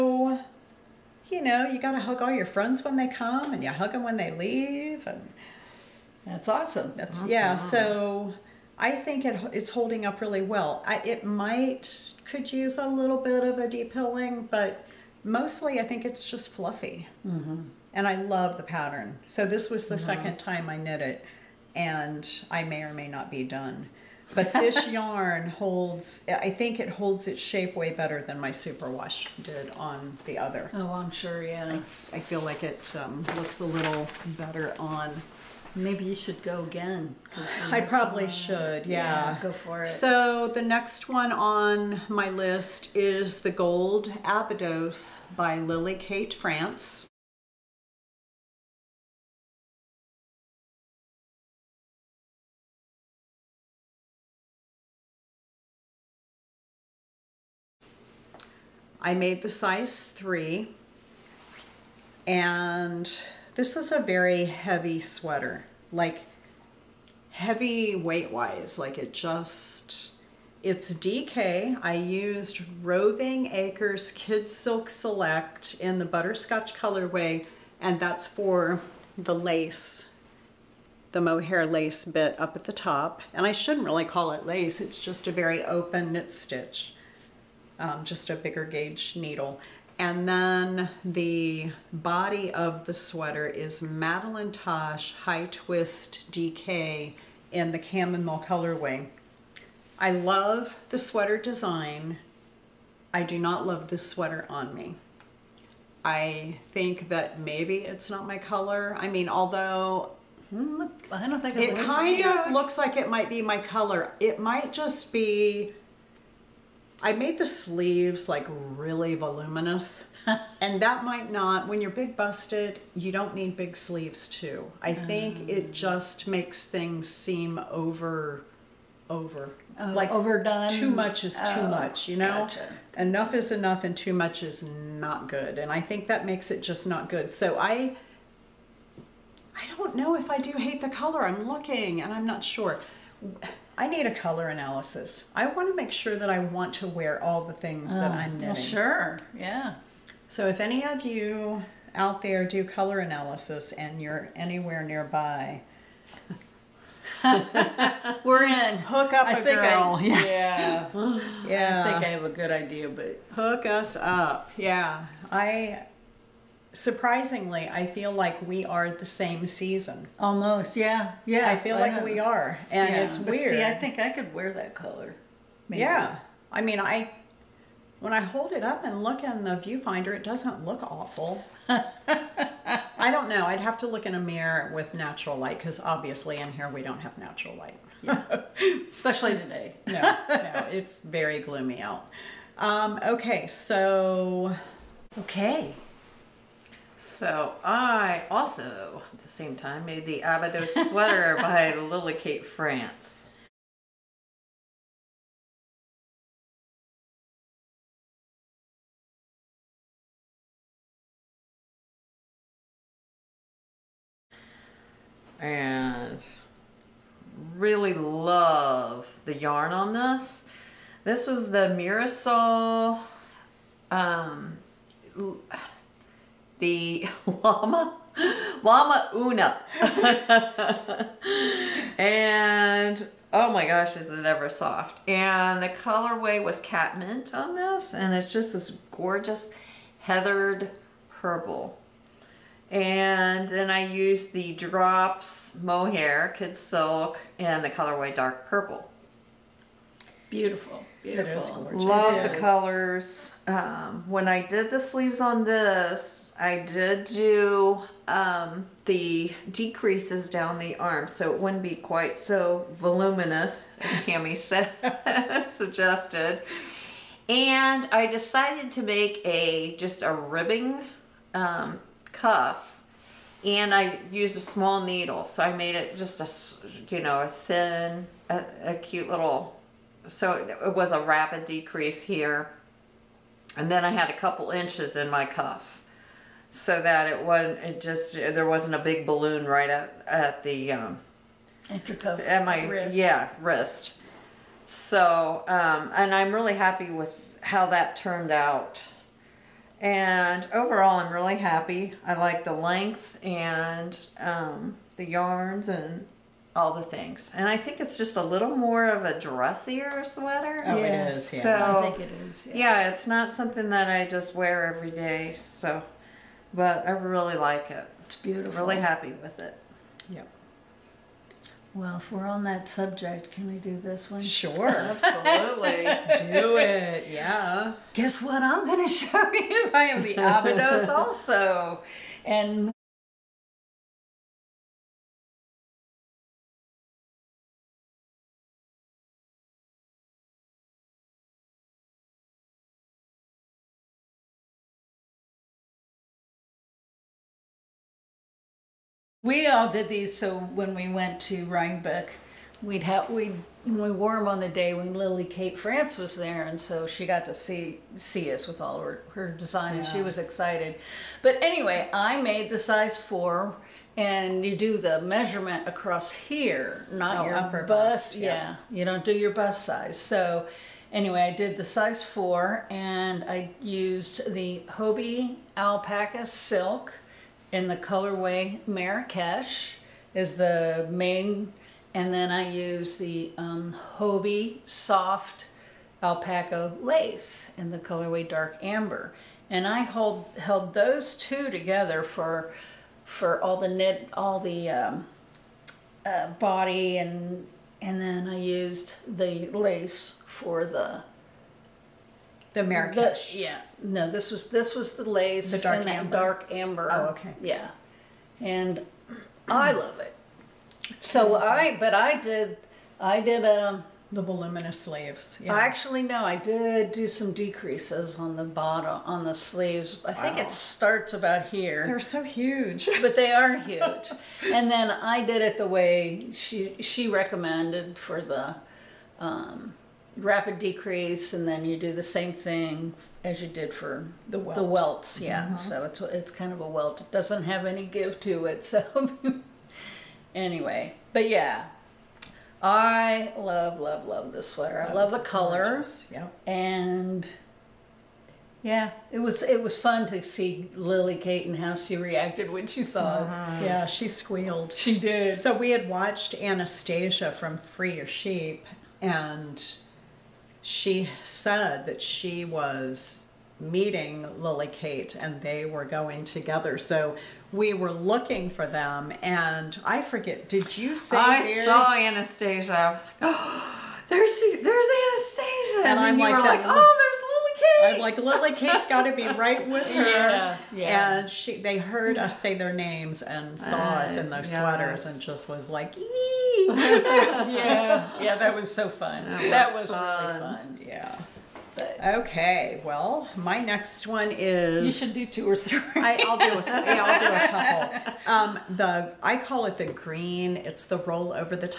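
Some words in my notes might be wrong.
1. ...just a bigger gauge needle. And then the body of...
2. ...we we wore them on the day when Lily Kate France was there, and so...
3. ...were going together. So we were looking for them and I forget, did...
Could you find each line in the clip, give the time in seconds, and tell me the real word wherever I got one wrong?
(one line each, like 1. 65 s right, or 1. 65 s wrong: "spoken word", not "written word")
1. 88 s right
2. 353 s right
3. 465 s right.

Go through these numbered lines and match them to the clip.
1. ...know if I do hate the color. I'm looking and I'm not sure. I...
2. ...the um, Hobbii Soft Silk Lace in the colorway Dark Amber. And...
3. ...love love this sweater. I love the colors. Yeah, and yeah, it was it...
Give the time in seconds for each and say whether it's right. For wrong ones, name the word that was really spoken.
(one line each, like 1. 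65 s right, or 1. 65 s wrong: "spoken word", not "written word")
1. 139 s right
2. 382 s wrong: "Alpaca", not "Silk"
3. 443 s right.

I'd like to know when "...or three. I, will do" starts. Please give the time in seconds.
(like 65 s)
495 s.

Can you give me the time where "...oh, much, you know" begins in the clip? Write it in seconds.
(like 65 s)
131 s.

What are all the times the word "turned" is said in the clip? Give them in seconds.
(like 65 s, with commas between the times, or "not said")
297 s.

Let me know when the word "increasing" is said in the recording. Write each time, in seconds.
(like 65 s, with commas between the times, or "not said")
not said.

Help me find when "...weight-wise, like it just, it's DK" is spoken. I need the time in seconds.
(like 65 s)
67 s.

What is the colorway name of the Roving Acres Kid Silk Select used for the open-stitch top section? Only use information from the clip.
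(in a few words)
Butterscotch.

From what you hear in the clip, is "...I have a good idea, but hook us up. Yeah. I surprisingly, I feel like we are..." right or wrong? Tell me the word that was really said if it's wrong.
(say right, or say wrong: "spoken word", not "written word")
right.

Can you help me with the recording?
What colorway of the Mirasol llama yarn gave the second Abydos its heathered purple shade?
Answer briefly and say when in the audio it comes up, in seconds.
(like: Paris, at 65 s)
Cat mint, at 236 s.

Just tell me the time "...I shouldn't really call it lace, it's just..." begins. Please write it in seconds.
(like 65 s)
83 s.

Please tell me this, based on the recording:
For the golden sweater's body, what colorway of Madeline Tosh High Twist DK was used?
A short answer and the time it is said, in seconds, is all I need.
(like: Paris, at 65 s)
Chamomile, at 97 s.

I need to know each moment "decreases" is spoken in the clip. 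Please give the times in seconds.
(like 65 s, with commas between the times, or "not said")
259 s, 281 s, 417 s, 430 s.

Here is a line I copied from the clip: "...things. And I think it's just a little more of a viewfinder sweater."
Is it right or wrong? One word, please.
wrong.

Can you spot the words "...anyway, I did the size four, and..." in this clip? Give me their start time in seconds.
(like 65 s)
370 s.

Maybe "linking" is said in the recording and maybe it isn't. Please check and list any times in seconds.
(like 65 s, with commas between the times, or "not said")
not said.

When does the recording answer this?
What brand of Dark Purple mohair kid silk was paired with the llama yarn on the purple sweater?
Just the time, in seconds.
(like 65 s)
244 s.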